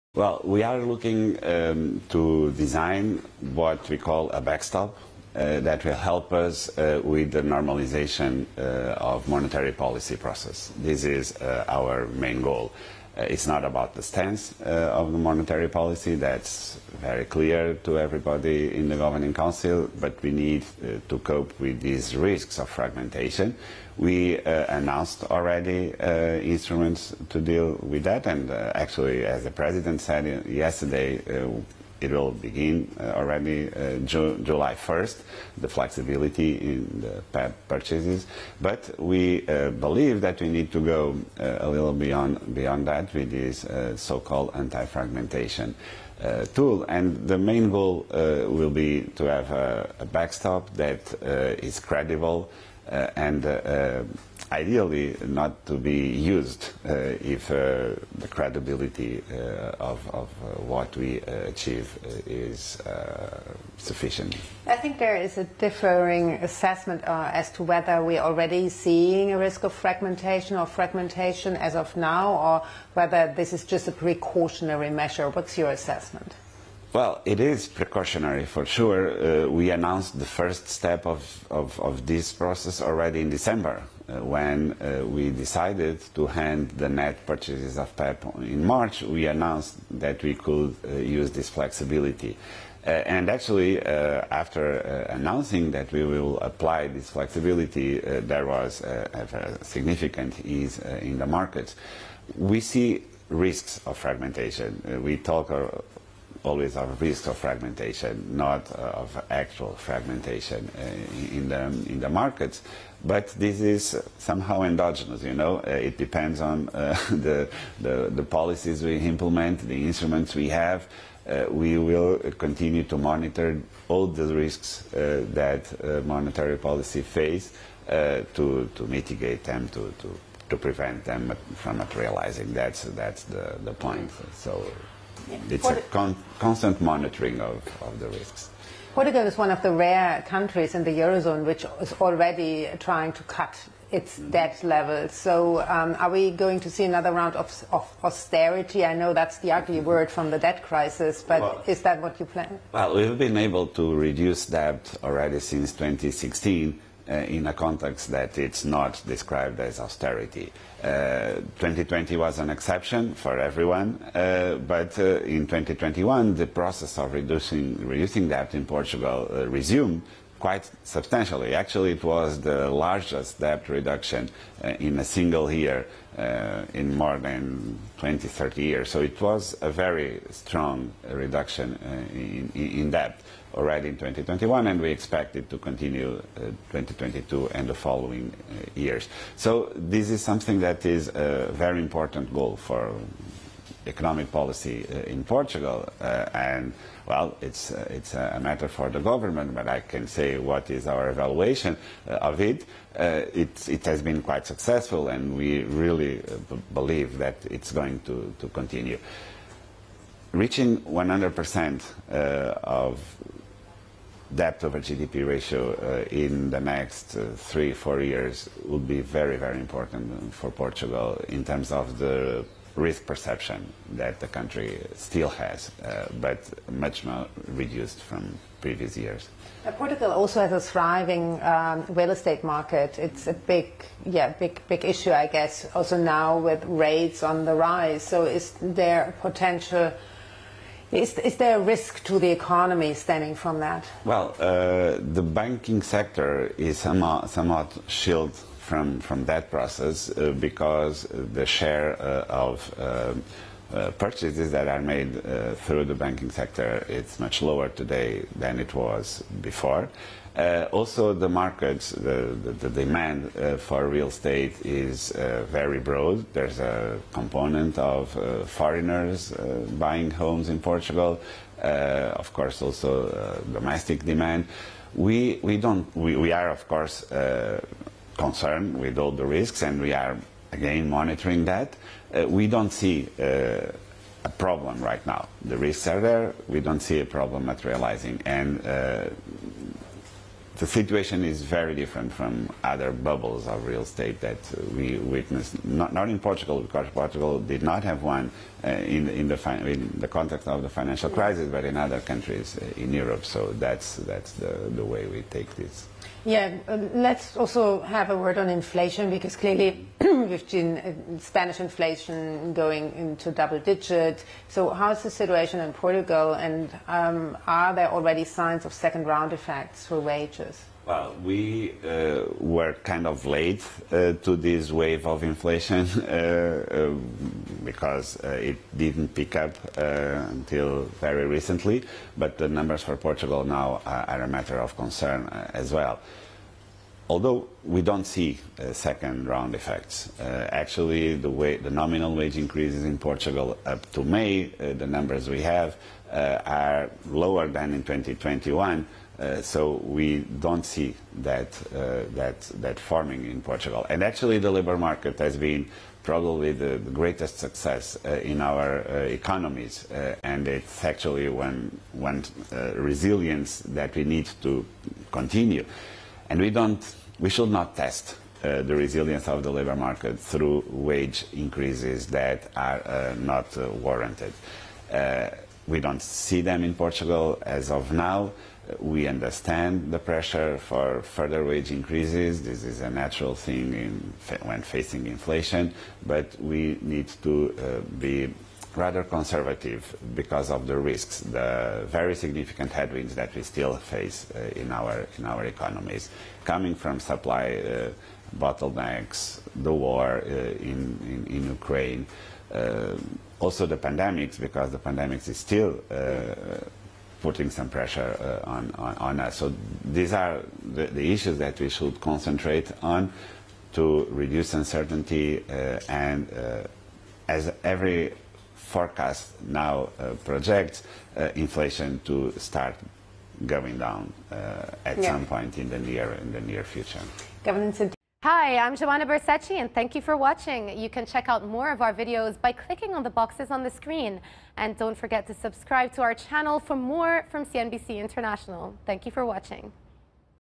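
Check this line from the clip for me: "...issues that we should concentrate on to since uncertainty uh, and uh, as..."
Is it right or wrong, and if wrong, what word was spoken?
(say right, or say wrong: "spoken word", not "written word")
wrong: "reduce", not "since".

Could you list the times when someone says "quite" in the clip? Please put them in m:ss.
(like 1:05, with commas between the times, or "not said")
2:50, 3:24.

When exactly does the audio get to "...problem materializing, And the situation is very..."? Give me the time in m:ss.
4:47.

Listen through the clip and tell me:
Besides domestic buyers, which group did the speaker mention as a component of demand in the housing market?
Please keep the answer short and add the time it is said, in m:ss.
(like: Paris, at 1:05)
Foreigners, at 4:28.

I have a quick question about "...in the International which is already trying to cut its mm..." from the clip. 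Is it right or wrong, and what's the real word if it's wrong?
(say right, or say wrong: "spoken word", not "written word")
wrong: "Eurozone", not "International".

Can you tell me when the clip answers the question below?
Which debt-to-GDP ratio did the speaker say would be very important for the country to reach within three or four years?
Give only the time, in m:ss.
3:30.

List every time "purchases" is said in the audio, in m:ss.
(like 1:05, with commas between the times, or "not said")
0:37, 1:27, 4:13.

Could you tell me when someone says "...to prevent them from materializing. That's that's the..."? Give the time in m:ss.
2:10.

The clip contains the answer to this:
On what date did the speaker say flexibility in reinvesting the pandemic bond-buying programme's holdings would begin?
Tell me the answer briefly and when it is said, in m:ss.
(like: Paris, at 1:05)
July 1st, at 0:33.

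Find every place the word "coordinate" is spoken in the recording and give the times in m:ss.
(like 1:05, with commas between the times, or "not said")
not said.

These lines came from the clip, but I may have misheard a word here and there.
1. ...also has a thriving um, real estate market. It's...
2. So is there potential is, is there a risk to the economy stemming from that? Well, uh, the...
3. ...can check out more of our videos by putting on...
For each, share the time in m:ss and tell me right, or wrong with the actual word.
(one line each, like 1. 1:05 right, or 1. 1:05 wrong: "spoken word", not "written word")
1. 3:50 right
2. 3:58 right
3. 7:10 wrong: "clicking", not "putting".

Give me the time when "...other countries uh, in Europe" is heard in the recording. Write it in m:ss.
5:01.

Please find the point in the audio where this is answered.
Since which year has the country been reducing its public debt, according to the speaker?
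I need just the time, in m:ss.
2:35.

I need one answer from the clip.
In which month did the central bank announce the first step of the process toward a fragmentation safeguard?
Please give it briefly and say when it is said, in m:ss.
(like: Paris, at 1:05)
December, at 1:23.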